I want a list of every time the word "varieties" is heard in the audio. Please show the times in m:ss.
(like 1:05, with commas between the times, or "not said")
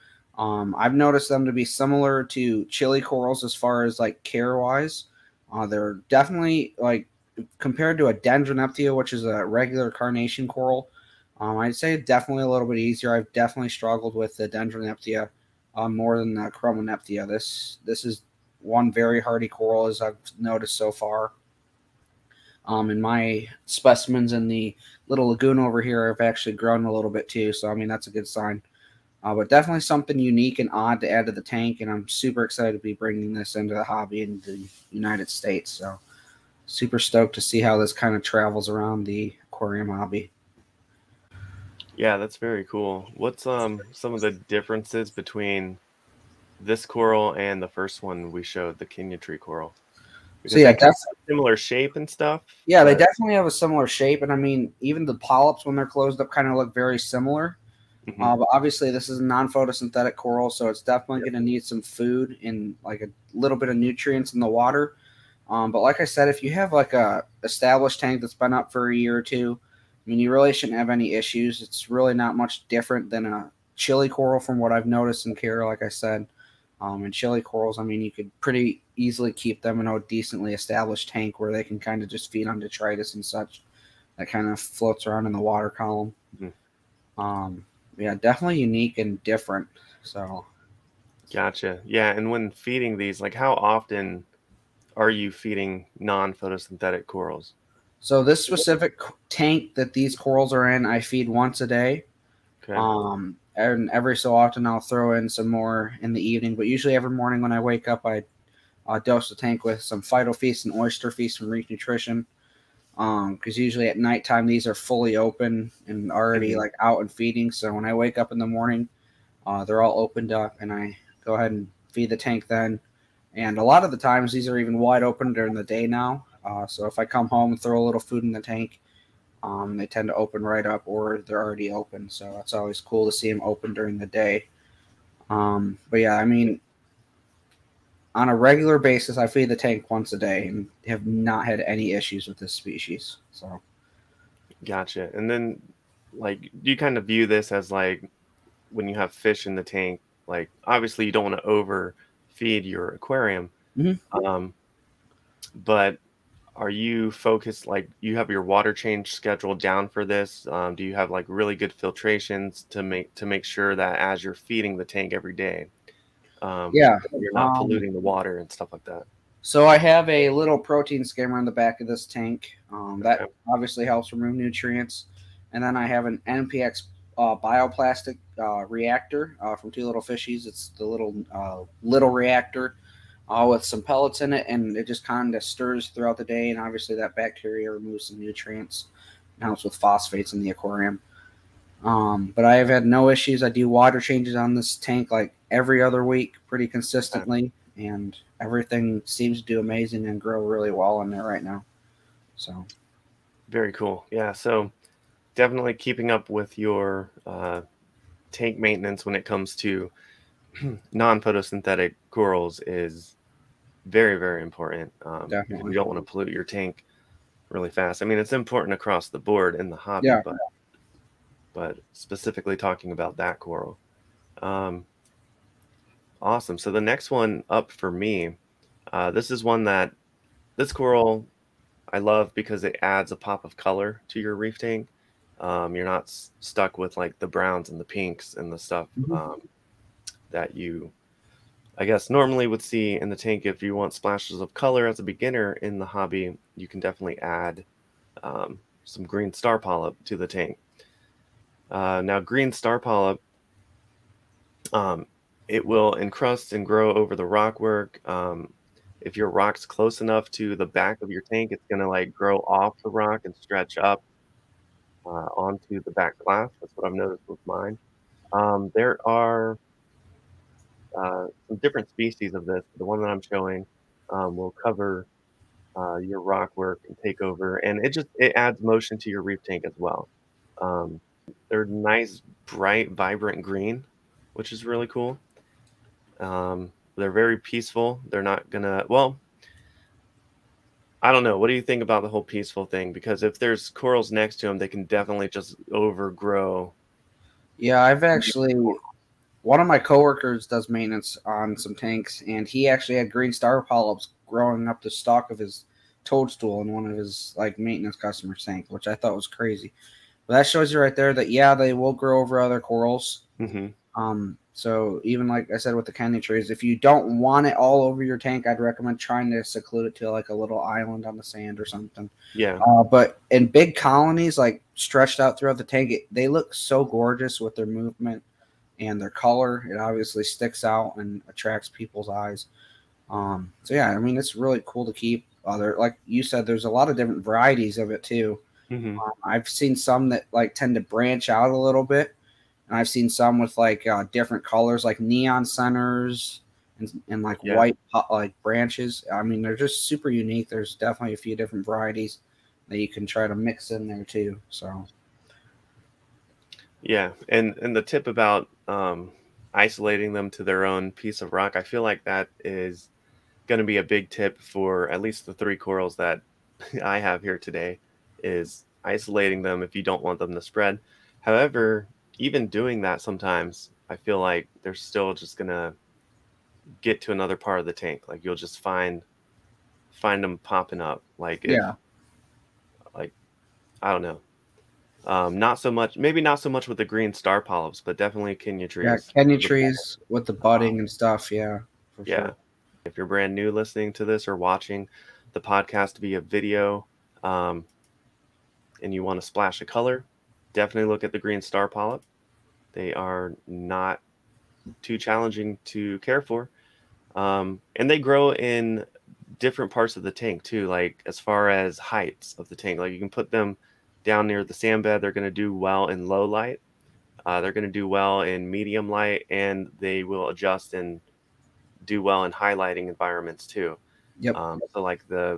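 5:37, 5:51.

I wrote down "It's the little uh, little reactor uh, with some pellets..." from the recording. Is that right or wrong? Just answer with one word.
right.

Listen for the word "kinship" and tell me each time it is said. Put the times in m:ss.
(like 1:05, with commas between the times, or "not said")
not said.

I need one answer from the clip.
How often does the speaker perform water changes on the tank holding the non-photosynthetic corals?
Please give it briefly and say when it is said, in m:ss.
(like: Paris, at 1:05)
Every other week, at 3:15.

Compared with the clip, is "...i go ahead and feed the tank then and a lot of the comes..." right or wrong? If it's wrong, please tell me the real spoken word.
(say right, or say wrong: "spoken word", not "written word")
wrong: "times", not "comes".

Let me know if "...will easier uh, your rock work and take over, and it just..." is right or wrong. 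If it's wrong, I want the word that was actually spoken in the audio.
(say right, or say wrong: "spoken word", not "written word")
wrong: "cover", not "easier".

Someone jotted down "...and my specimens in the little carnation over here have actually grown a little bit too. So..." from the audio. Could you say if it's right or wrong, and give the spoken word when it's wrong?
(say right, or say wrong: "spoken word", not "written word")
wrong: "lagoon", not "carnation".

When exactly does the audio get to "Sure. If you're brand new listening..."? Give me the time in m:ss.
6:32.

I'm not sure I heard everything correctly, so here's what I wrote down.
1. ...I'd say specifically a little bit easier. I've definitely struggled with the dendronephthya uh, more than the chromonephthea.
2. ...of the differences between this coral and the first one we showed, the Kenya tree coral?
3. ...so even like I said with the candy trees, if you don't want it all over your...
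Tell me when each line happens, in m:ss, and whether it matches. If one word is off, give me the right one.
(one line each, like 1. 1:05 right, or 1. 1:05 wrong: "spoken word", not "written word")
1. 0:11 wrong: "definitely", not "specifically"
2. 0:44 right
3. 5:14 right.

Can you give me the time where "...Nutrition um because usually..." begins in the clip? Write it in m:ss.
1:51.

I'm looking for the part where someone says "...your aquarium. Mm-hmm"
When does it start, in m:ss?
2:32.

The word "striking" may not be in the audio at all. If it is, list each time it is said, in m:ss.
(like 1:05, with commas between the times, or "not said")
not said.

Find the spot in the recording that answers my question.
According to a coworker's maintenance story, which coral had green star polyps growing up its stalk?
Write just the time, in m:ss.
5:06.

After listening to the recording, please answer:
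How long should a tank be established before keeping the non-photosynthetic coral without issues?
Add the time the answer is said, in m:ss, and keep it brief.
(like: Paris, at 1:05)
A year or two, at 1:08.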